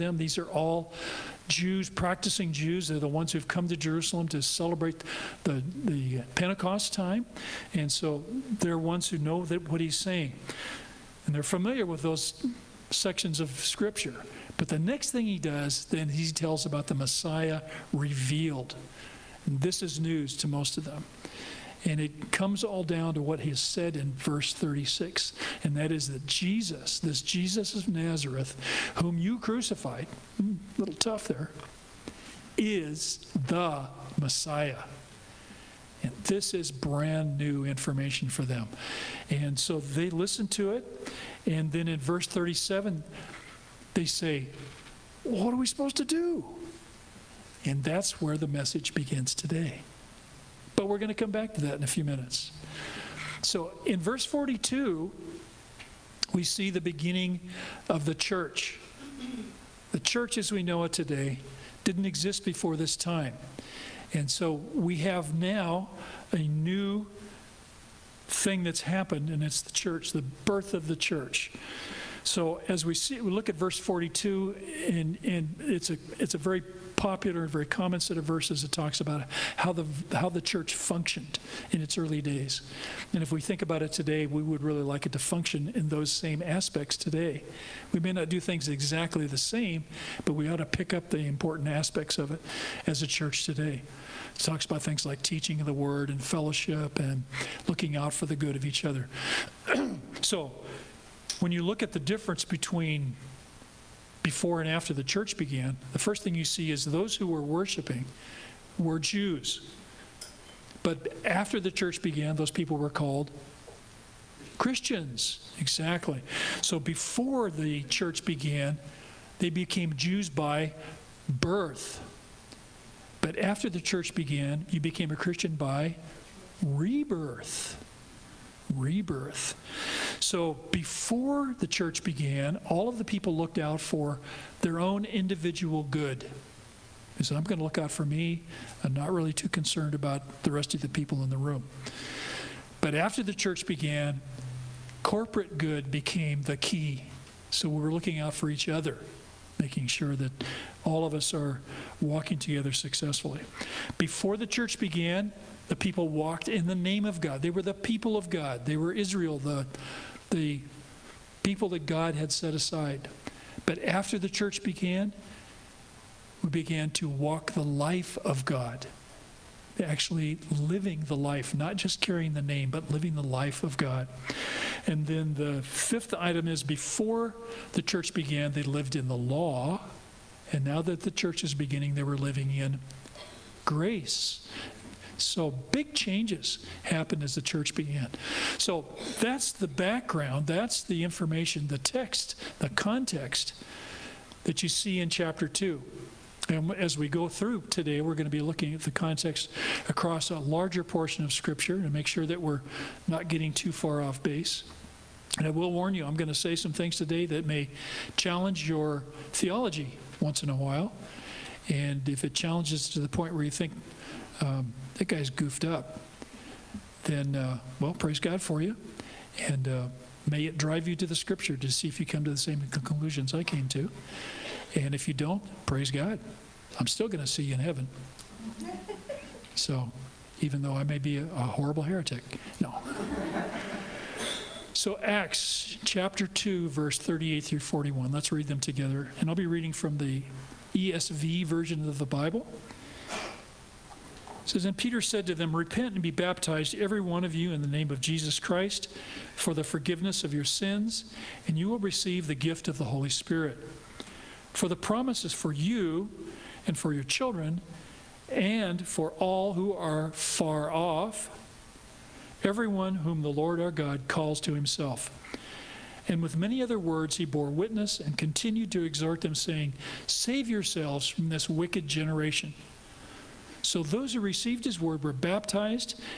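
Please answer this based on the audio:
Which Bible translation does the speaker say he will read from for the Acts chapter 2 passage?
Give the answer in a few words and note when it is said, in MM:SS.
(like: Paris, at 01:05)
ESV, at 04:00.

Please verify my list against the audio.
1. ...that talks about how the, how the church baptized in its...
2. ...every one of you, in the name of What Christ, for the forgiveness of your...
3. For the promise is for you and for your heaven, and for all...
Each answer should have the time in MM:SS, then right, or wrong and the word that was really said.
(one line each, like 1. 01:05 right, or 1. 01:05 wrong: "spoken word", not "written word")
1. 01:18 wrong: "functioned", not "baptized"
2. 04:06 wrong: "Jesus", not "What"
3. 04:14 wrong: "children", not "heaven".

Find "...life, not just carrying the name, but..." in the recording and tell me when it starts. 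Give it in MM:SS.
02:51.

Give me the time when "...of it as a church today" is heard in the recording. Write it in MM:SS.
01:32.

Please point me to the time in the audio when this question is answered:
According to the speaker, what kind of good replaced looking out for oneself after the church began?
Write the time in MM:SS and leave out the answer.
02:25.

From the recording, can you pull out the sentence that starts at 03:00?
And now that the church is beginning, they were living in grace.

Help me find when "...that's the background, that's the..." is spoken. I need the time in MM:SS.
03:09.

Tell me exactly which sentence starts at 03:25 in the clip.
And I will warn you, I'm going to say some things today that may challenge your theology once in a while.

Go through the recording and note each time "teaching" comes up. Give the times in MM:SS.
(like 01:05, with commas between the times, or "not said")
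01:35.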